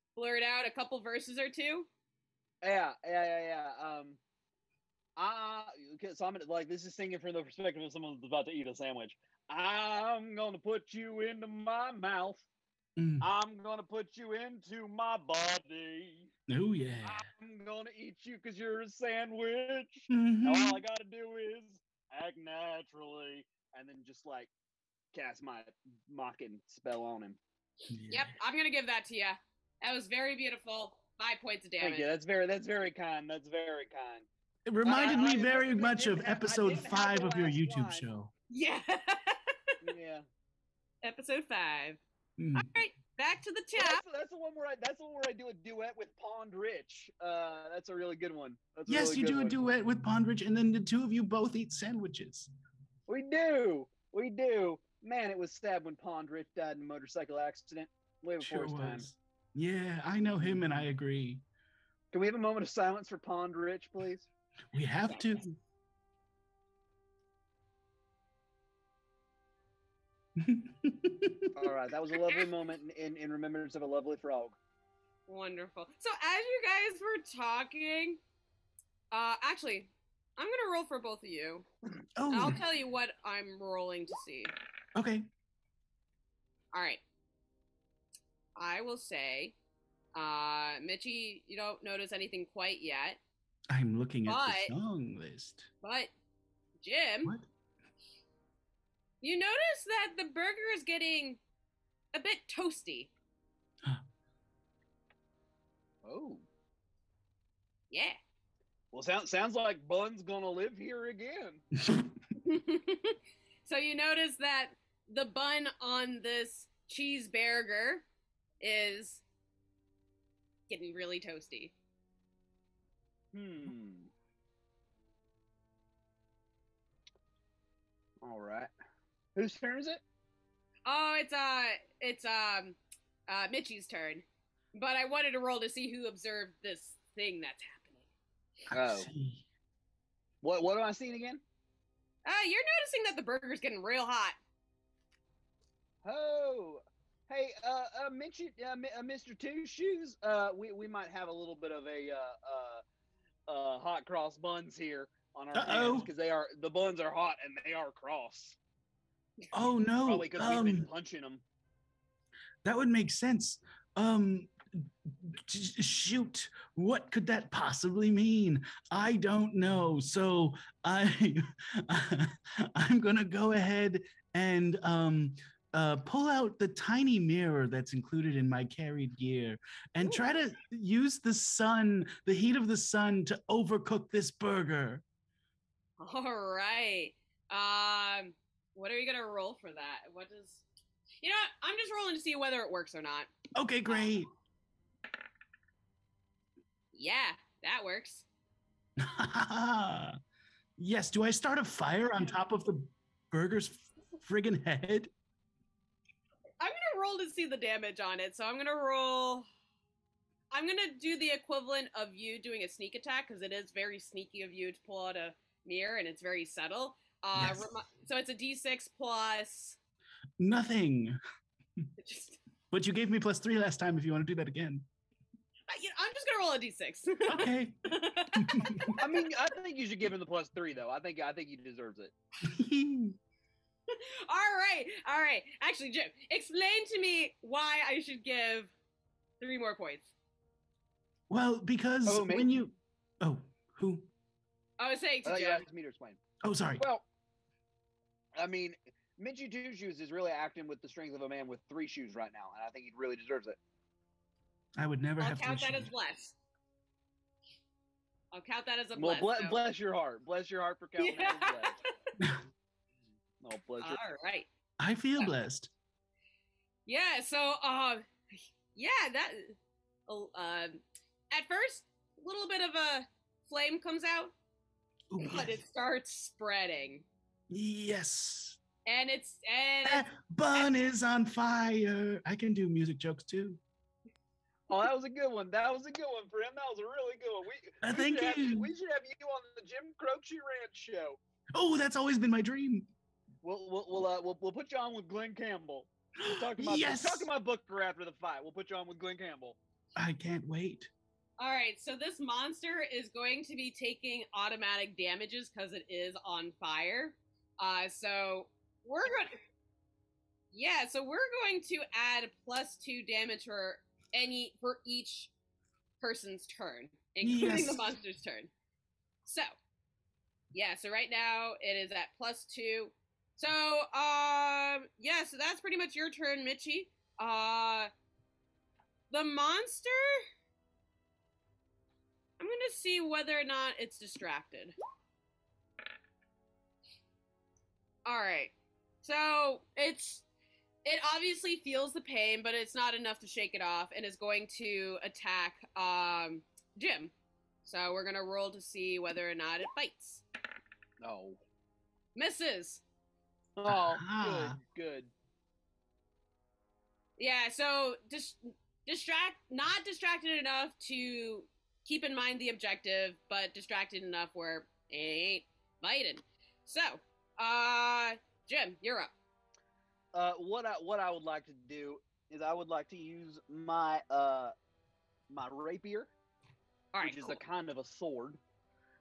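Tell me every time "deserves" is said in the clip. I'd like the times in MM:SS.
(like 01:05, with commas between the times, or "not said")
03:51, 04:13.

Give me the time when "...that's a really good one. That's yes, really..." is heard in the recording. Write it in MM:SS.
00:47.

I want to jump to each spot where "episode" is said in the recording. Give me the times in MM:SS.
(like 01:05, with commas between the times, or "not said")
00:36, 00:41.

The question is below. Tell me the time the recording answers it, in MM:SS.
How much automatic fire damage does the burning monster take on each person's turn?
05:12.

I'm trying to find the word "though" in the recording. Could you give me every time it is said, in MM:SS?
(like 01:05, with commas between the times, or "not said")
03:50.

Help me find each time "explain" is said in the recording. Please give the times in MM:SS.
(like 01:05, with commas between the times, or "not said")
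03:56, 04:05.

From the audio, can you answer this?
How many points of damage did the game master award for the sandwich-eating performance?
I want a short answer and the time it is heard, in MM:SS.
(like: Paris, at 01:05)
5, at 00:31.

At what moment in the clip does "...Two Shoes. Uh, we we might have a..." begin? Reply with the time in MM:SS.
02:29.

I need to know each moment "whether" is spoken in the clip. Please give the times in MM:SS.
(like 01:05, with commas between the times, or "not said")
03:12, 05:33, 05:48.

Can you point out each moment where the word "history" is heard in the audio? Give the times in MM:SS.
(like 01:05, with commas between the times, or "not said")
not said.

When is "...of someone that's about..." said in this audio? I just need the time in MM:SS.
00:07.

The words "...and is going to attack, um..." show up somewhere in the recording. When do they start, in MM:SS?
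05:43.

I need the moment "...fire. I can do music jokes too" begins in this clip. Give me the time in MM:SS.
04:41.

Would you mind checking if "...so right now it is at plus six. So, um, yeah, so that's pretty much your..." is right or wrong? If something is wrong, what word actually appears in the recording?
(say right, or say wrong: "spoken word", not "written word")
wrong: "two", not "six".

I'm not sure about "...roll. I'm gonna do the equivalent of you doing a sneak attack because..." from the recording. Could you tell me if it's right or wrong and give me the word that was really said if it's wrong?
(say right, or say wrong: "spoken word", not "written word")
right.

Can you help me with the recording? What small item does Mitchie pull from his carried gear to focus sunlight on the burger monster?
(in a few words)
tiny mirror.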